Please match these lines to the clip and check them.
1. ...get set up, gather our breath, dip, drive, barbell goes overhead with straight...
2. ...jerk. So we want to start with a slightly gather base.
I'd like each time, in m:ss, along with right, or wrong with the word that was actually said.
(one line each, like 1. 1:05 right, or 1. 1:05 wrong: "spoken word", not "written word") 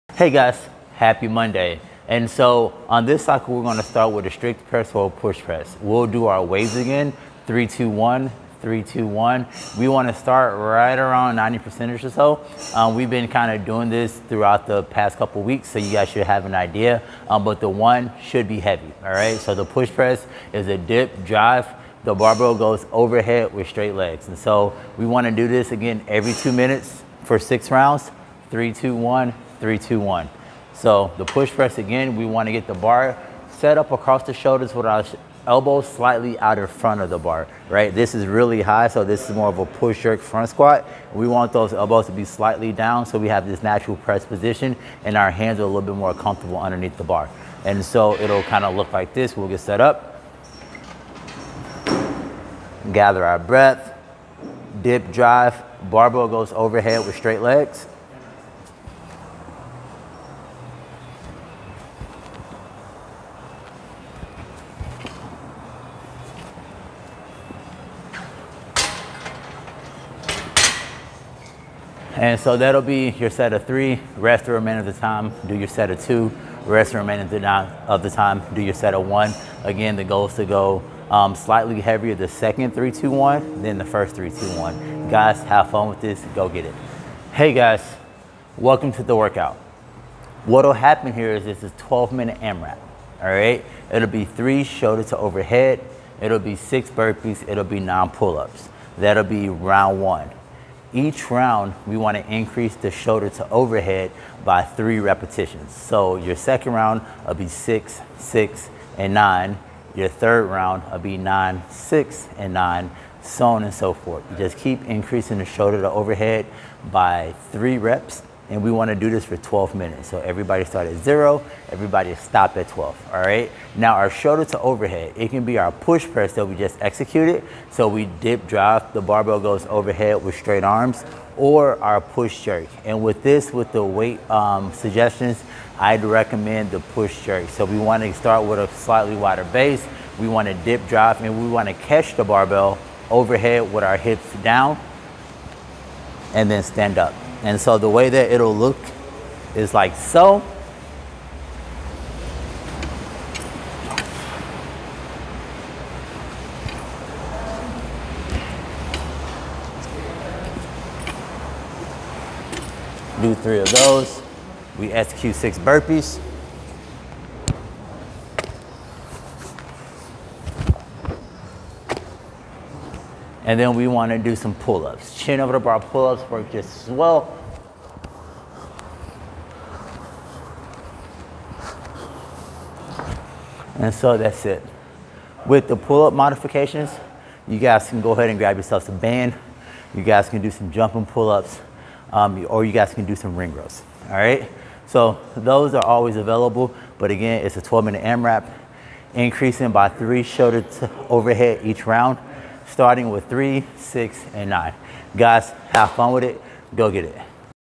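1. 0:49 right
2. 2:17 wrong: "wider", not "gather".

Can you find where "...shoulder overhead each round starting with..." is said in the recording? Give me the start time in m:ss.
3:20.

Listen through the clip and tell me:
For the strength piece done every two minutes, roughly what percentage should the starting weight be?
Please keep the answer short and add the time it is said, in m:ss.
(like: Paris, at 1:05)
90%, at 0:11.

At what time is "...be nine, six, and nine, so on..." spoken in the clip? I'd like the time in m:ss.
1:50.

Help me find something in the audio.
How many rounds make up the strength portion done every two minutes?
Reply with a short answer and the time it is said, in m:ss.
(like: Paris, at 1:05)
6, at 0:27.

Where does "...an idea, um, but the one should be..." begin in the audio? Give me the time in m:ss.
0:16.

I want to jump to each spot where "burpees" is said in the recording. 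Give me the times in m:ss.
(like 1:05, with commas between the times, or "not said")
1:36, 2:45.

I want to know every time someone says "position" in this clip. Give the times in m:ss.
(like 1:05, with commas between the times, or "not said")
0:44.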